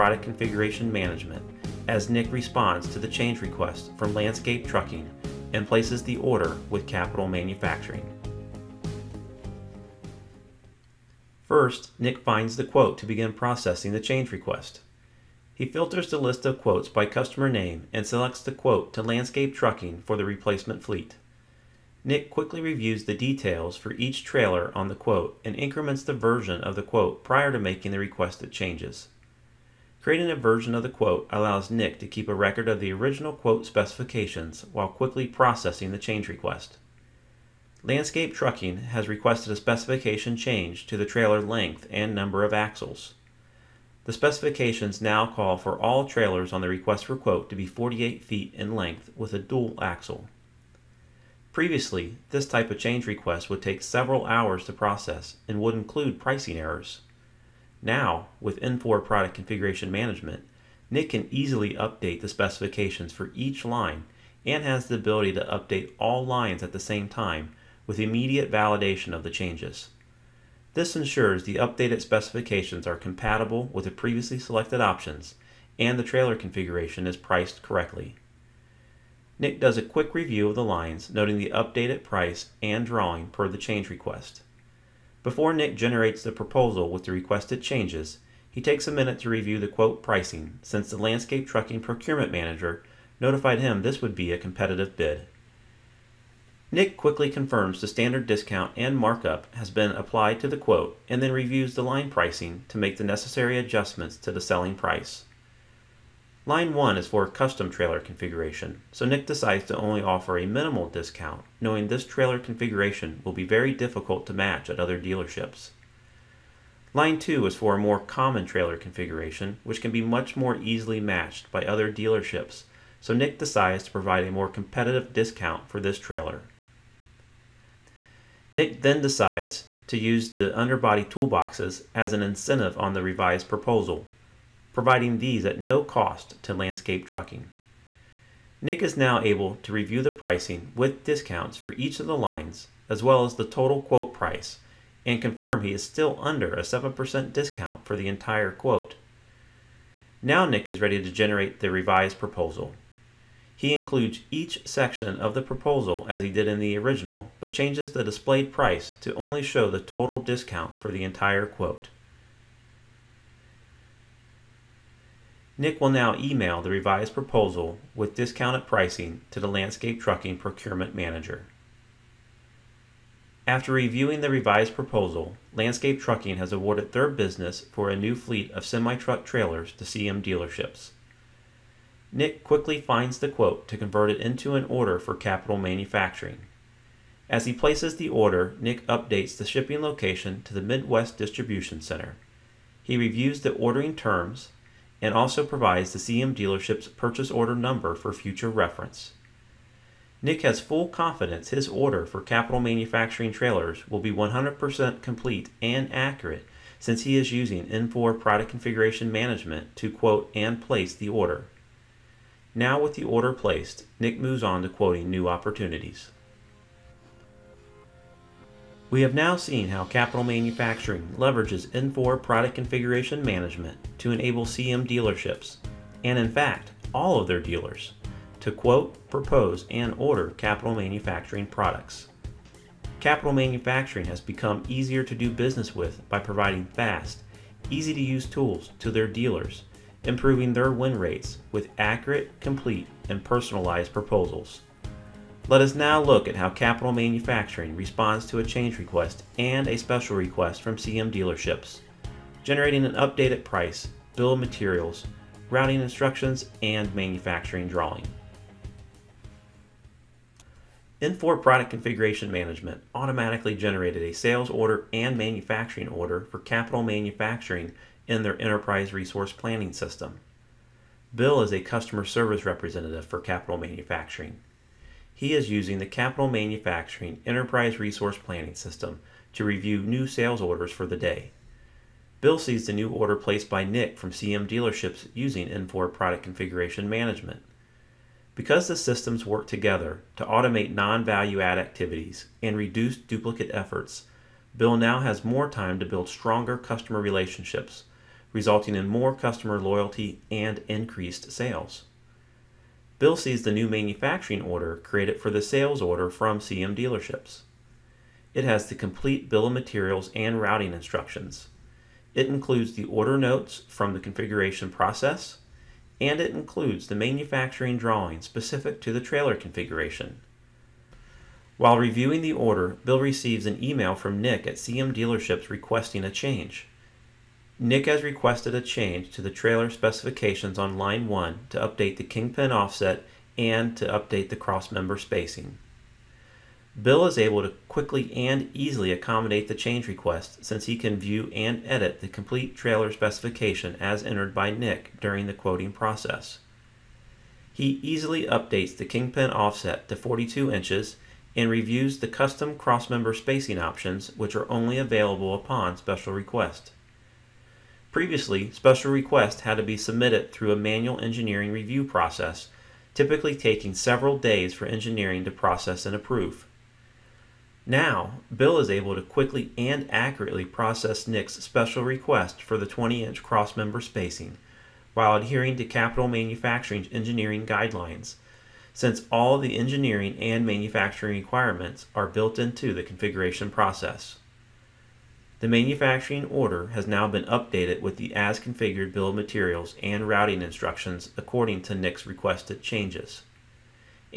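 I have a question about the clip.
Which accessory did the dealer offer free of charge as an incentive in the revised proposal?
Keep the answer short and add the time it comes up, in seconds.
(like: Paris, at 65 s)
underbody toolboxes, at 130 s.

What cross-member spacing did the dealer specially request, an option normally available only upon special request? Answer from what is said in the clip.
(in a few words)
20-inch.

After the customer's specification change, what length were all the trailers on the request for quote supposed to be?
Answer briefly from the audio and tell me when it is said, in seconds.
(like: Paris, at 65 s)
48 feet, at 47 s.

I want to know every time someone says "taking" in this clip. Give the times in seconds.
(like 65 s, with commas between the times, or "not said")
363 s.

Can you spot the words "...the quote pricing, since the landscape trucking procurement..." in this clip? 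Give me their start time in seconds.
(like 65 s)
89 s.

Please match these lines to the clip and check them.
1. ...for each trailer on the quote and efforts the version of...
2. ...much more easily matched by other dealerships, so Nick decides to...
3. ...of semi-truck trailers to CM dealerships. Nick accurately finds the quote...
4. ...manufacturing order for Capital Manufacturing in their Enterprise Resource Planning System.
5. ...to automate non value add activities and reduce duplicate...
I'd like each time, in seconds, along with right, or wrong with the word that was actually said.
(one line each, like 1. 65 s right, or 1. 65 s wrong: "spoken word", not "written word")
1. 23 s wrong: "increments", not "efforts"
2. 120 s right
3. 178 s wrong: "quickly", not "accurately"
4. 265 s right
5. 290 s right.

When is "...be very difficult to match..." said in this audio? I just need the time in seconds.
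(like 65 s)
113 s.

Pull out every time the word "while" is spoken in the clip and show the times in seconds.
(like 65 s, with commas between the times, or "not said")
34 s, 321 s, 374 s.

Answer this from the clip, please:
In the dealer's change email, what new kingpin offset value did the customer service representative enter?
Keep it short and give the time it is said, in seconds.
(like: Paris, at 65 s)
42 inches, at 349 s.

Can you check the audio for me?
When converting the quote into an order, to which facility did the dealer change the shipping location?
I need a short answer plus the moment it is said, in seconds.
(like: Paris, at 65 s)
Midwest Distribution Center, at 190 s.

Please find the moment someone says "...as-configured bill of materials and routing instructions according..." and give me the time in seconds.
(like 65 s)
388 s.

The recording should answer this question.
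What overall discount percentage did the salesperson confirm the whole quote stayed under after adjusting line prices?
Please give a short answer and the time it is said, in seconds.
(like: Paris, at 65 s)
7%, at 146 s.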